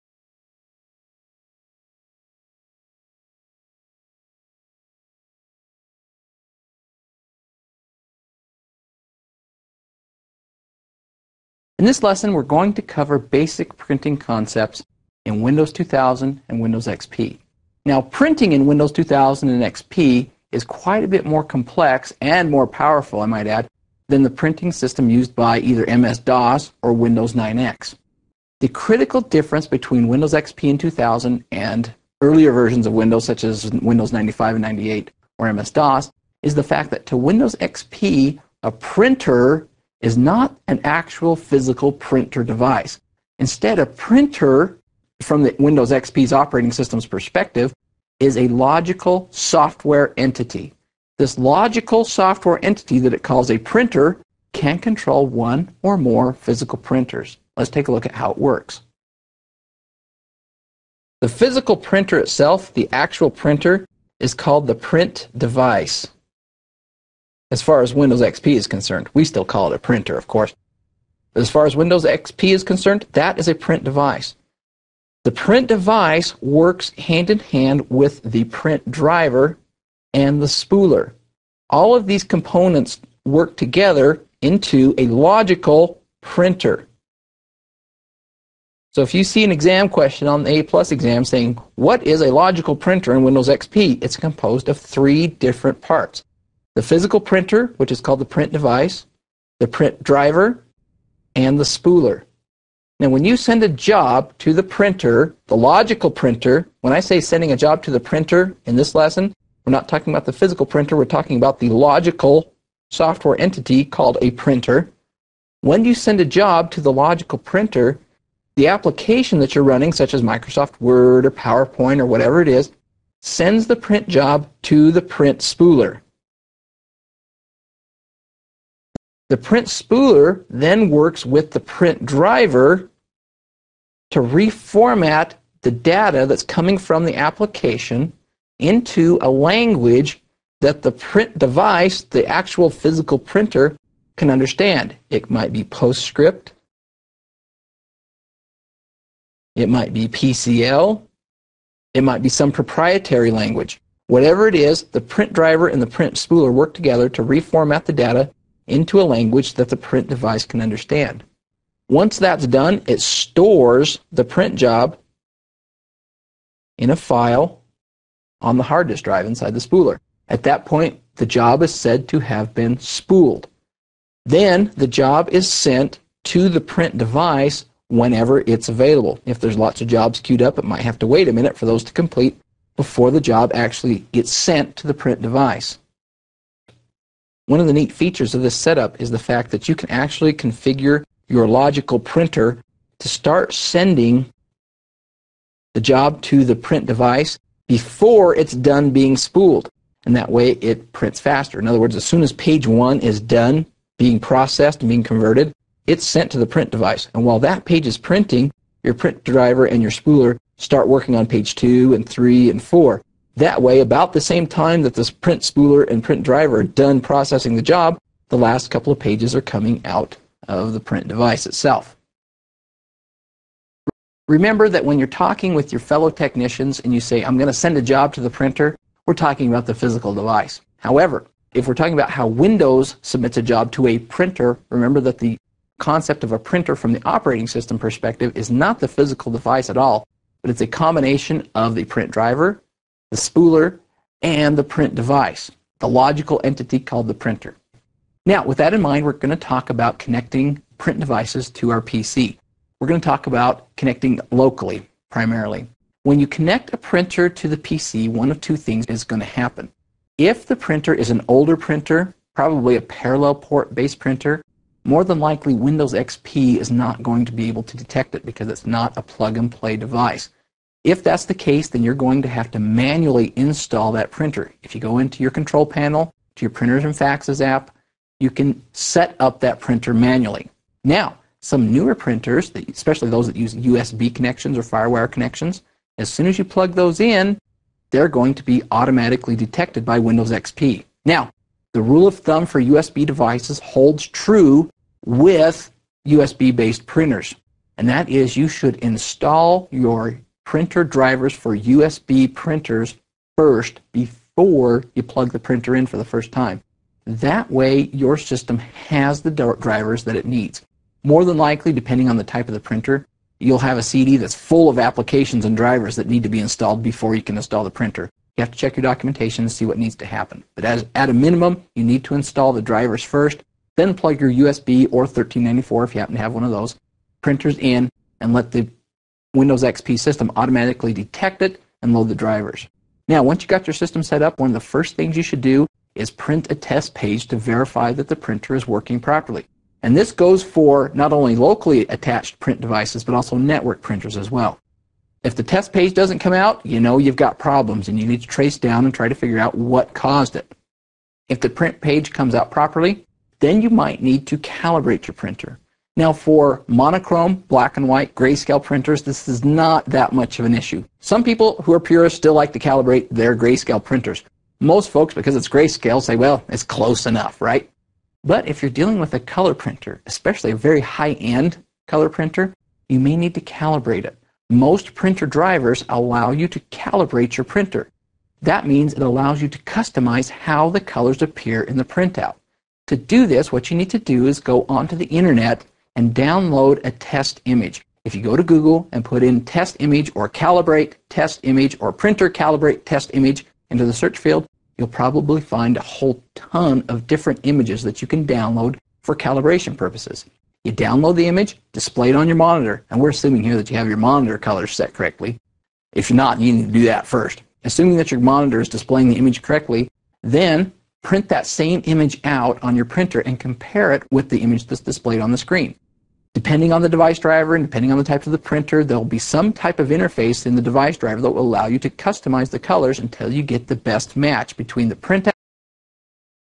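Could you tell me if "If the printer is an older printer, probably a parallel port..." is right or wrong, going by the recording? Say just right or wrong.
right.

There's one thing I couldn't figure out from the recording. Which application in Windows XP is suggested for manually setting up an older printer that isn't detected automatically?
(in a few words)
Printers and Faxes.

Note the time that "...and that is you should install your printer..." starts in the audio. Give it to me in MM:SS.
04:57.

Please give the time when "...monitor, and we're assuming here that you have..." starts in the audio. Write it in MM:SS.
06:42.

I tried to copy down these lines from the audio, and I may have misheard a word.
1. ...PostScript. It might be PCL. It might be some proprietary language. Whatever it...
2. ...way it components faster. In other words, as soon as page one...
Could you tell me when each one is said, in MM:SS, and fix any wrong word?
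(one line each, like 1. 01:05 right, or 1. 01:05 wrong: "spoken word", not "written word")
1. 02:25 right
2. 03:20 wrong: "prints", not "components".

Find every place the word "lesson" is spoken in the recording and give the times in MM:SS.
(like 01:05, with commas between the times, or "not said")
00:12, 01:48.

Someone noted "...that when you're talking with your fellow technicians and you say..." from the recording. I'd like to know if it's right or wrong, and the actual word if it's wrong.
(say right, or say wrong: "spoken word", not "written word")
right.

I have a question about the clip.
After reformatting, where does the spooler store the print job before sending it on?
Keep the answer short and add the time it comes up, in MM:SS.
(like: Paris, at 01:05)
hard disk drive, at 02:48.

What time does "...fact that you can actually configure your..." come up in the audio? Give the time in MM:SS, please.
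03:09.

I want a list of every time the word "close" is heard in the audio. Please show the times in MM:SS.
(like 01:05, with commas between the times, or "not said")
06:06.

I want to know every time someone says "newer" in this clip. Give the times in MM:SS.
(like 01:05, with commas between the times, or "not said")
04:41.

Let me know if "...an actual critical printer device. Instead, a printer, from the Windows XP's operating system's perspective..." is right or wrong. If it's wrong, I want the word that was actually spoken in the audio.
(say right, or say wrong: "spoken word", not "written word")
wrong: "physical", not "critical".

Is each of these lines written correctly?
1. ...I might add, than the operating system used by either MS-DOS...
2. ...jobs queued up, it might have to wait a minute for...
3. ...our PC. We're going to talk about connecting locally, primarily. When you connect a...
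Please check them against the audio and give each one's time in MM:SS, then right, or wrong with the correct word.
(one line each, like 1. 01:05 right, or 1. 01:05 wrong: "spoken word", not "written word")
1. 00:23 wrong: "printing", not "operating"
2. 02:59 right
3. 04:11 right.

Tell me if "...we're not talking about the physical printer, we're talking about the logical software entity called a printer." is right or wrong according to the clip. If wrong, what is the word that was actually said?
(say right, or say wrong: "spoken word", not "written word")
right.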